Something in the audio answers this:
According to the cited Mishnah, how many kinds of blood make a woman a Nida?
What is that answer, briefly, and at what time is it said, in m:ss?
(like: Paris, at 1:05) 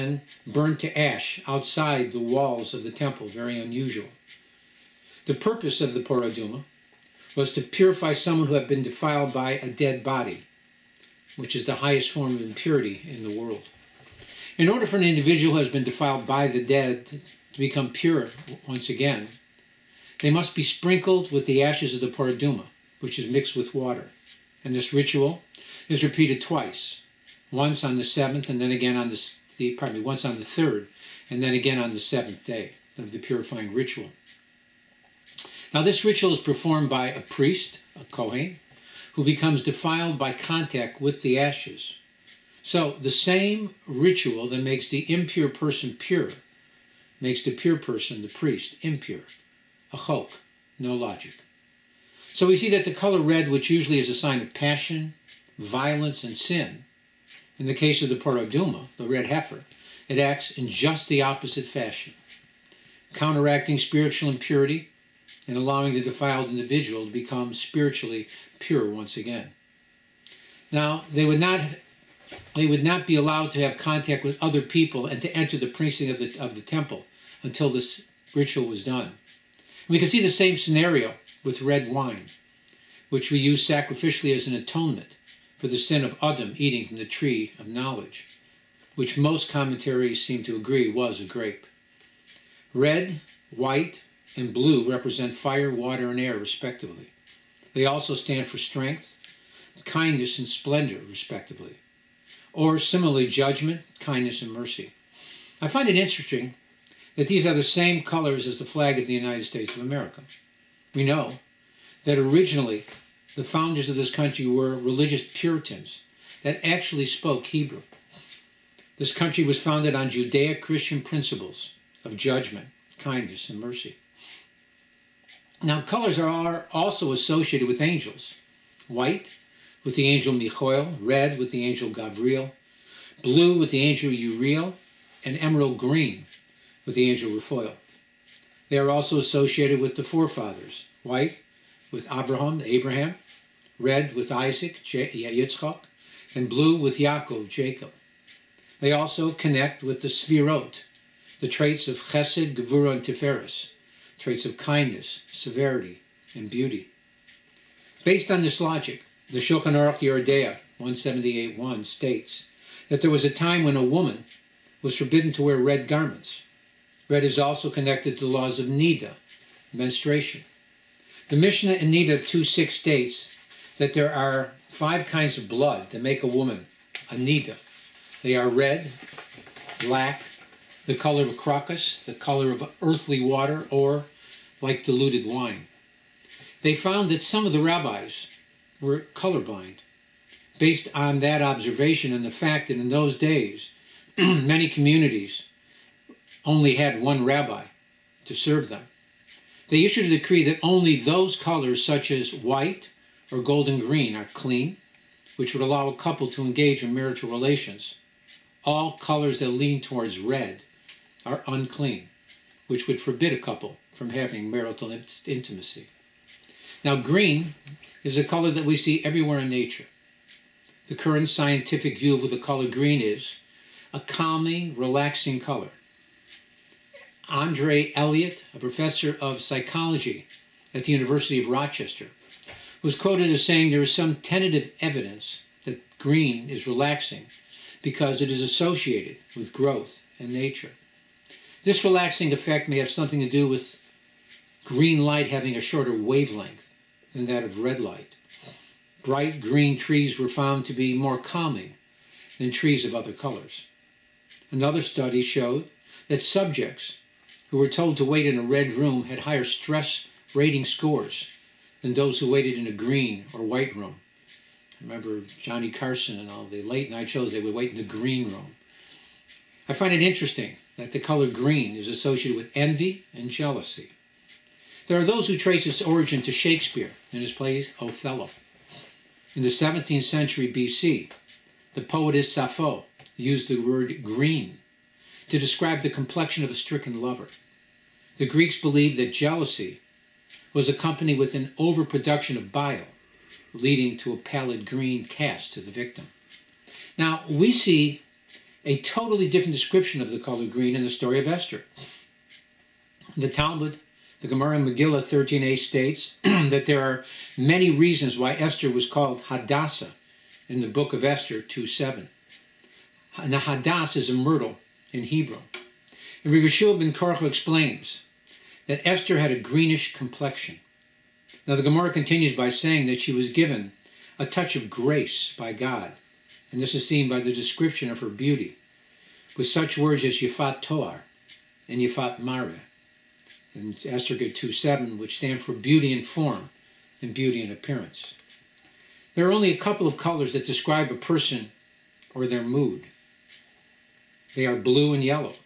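5, at 2:54.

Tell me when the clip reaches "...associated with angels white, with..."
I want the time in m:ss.
2:07.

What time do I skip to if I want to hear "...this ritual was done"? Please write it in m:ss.
1:17.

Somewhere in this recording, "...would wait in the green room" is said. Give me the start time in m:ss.
4:27.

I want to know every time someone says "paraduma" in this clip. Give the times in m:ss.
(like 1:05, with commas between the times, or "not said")
0:22, 0:58.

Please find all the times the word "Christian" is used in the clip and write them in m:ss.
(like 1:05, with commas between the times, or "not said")
2:00.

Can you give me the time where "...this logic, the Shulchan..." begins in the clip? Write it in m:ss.
2:38.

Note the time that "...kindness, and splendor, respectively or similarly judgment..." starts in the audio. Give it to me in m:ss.
1:39.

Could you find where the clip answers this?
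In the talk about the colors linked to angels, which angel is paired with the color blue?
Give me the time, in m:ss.
2:14.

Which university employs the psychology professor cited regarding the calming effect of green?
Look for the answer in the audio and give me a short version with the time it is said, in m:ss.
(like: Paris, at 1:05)
University of Rochester, at 3:50.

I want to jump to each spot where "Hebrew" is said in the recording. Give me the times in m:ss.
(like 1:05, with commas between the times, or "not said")
1:57, 5:15.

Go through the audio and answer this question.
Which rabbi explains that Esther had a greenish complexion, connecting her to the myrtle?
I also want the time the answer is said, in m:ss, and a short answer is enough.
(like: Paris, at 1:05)
Rabbi Yeshua ben Korach, at 5:16.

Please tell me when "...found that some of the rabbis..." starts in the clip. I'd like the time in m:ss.
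3:06.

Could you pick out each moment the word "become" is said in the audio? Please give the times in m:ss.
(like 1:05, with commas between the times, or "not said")
0:17, 0:39, 1:07.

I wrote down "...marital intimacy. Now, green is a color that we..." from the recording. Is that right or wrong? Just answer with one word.
right.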